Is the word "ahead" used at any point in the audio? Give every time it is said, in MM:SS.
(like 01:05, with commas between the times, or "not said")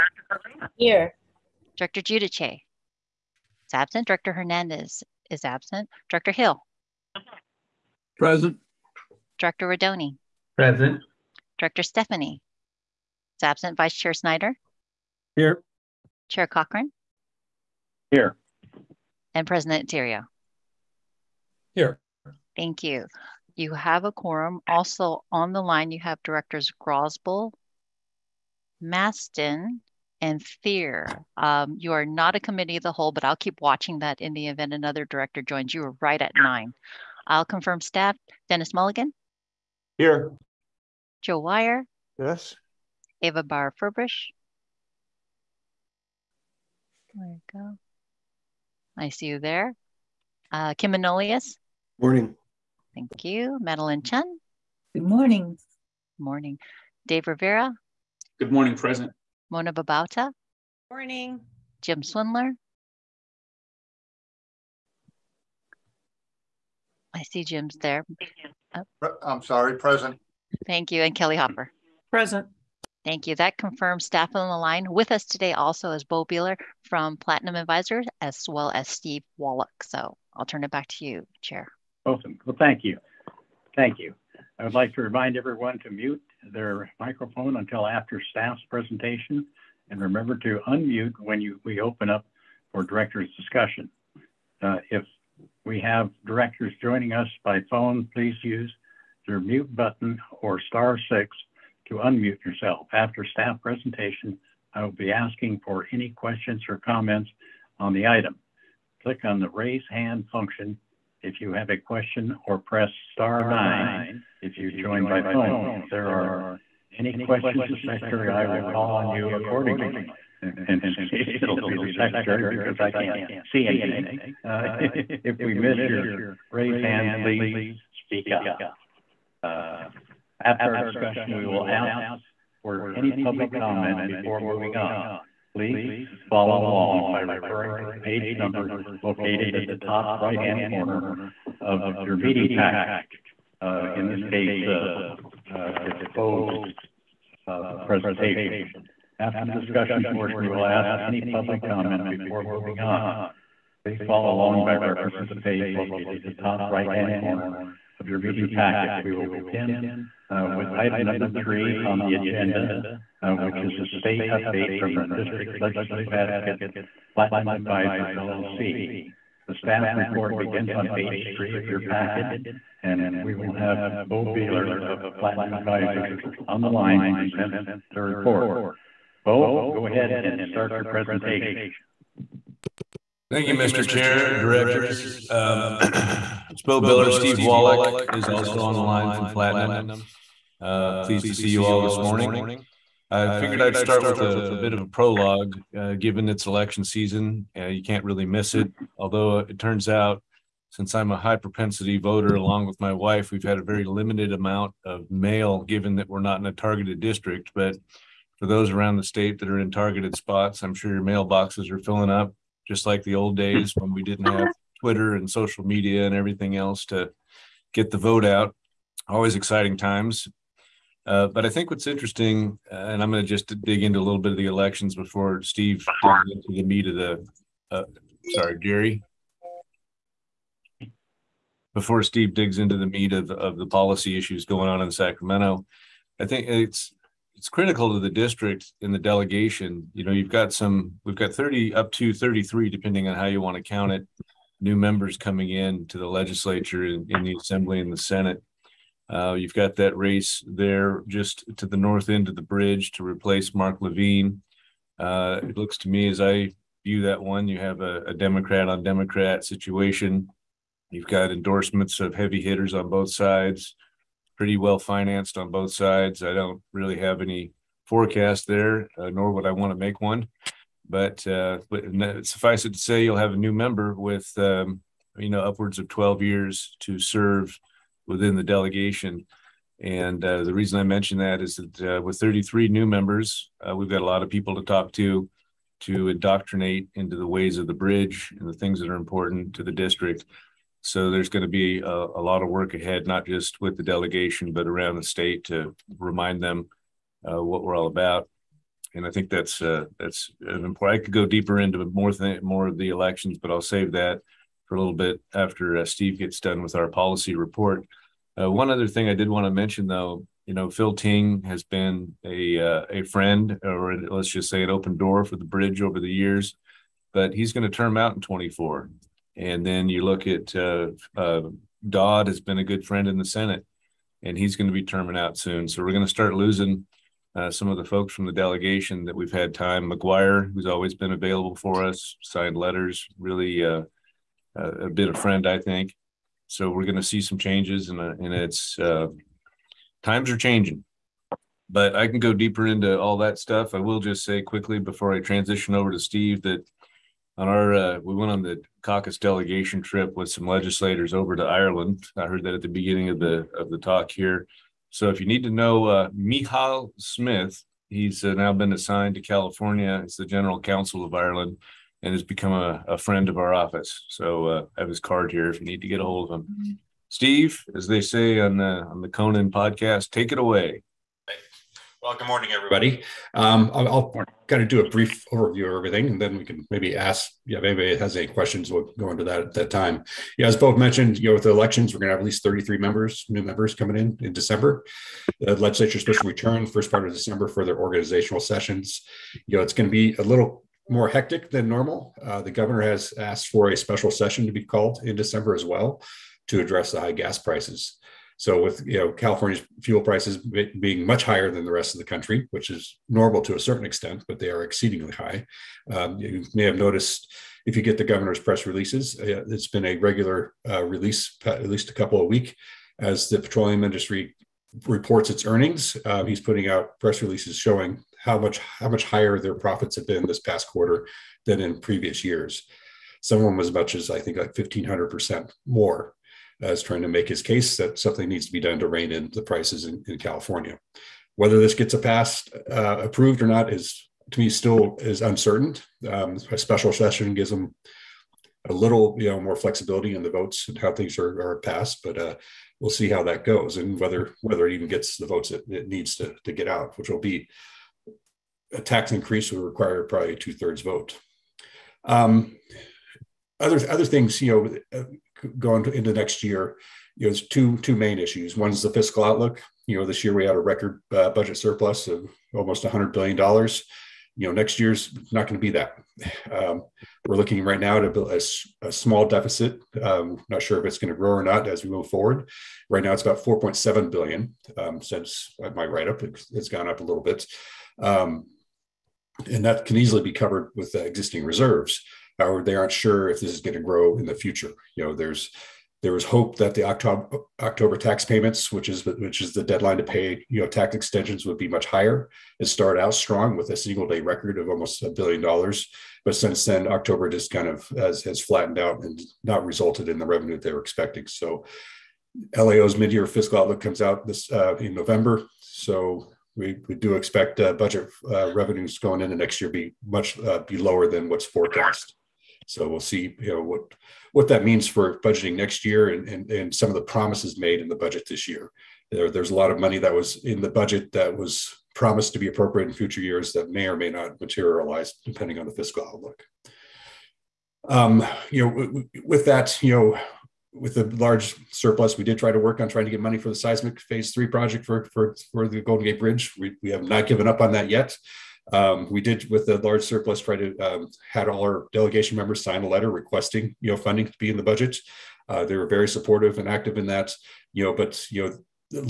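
02:59, 04:52.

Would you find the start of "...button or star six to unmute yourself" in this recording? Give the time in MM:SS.
01:39.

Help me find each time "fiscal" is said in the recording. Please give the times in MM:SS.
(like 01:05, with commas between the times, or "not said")
07:38, 08:23, 08:45.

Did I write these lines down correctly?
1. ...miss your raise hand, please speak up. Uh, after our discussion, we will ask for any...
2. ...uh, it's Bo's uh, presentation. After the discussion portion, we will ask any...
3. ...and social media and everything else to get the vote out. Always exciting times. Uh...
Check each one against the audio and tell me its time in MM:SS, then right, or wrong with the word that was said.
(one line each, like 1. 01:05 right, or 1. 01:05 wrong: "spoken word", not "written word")
1. 02:05 right
2. 02:25 right
3. 03:35 right.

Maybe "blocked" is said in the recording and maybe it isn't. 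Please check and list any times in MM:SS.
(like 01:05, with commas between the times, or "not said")
not said.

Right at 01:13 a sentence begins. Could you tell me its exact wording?
That confirms staff on the line.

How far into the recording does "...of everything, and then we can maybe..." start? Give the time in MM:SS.
06:15.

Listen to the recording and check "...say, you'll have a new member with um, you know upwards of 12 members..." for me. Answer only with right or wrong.
wrong.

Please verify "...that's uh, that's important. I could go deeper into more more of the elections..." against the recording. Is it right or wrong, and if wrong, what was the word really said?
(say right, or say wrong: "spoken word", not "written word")
right.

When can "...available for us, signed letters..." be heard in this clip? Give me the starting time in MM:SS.
05:31.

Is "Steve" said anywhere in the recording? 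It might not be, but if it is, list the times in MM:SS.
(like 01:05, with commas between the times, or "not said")
01:18, 03:07, 03:45, 03:52, 05:05, 05:45, 06:07.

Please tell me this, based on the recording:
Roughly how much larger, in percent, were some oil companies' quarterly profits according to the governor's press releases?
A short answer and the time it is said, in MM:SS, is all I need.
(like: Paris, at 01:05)
1500 percent, at 07:04.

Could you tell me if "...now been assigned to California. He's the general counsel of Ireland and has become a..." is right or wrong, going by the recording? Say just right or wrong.
right.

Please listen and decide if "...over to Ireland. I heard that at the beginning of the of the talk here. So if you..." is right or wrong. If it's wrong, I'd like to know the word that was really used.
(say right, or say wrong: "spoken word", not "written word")
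right.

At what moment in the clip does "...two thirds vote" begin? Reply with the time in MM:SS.
07:30.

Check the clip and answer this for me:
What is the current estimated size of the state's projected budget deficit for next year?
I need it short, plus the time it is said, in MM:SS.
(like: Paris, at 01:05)
4.7 billion, at 07:53.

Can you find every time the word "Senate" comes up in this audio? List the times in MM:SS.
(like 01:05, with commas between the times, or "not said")
04:07, 05:23.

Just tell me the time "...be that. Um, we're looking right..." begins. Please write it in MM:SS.
07:45.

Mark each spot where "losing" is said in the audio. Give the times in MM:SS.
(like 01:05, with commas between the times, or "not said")
05:26.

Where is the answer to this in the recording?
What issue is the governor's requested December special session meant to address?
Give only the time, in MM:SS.
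06:36.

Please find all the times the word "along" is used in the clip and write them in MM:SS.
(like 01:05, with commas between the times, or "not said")
02:16, 02:34, 03:22.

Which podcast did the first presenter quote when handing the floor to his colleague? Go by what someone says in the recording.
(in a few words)
Conan podcast.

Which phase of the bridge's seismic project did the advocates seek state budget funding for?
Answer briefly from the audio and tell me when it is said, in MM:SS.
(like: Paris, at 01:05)
phase three, at 08:54.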